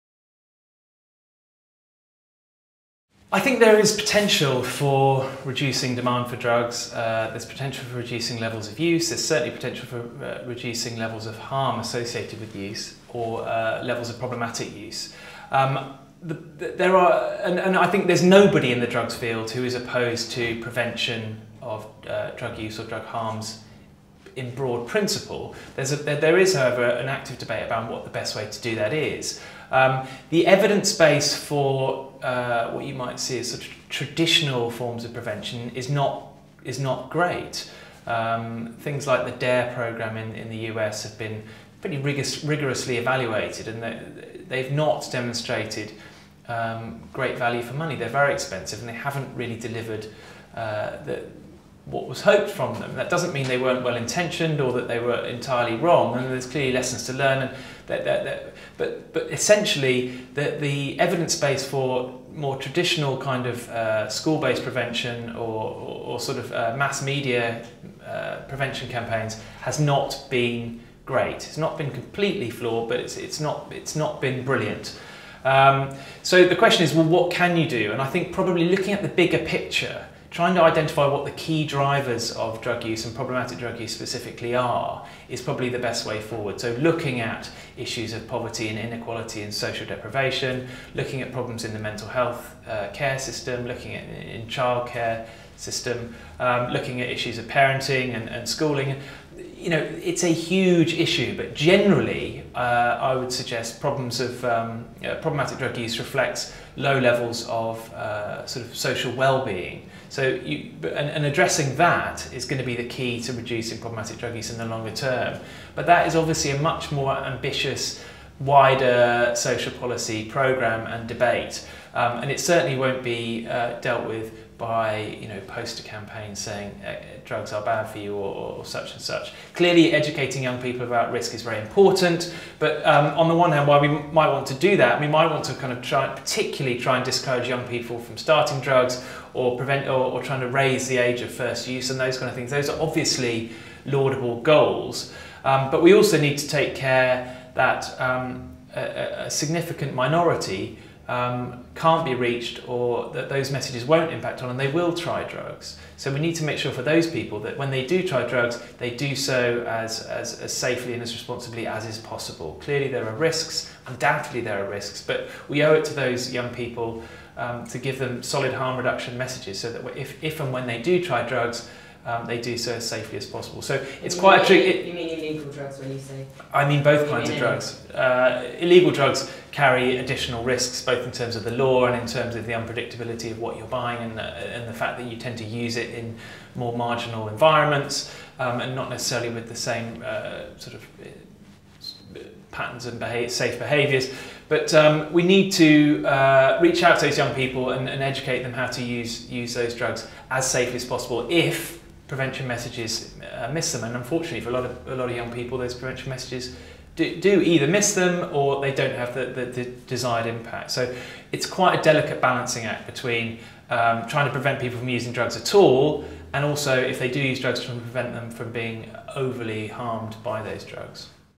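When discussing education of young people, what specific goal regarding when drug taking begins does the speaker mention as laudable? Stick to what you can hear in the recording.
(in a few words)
raise the age of first use.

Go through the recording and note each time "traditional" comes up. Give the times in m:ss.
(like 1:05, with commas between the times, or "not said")
0:33, 1:02.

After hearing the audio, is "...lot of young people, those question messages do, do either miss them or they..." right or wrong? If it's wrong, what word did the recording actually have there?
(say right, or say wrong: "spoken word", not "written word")
wrong: "prevention", not "question".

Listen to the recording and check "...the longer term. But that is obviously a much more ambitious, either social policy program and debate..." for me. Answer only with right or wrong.
wrong.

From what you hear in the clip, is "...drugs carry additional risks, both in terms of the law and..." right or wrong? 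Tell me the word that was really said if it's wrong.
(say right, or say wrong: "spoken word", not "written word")
right.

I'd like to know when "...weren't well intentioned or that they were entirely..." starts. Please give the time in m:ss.
0:53.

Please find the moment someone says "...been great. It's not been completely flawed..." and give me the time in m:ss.
1:10.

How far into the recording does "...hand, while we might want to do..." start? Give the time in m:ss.
2:13.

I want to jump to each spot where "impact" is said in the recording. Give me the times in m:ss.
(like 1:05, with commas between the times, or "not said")
2:34, 3:30.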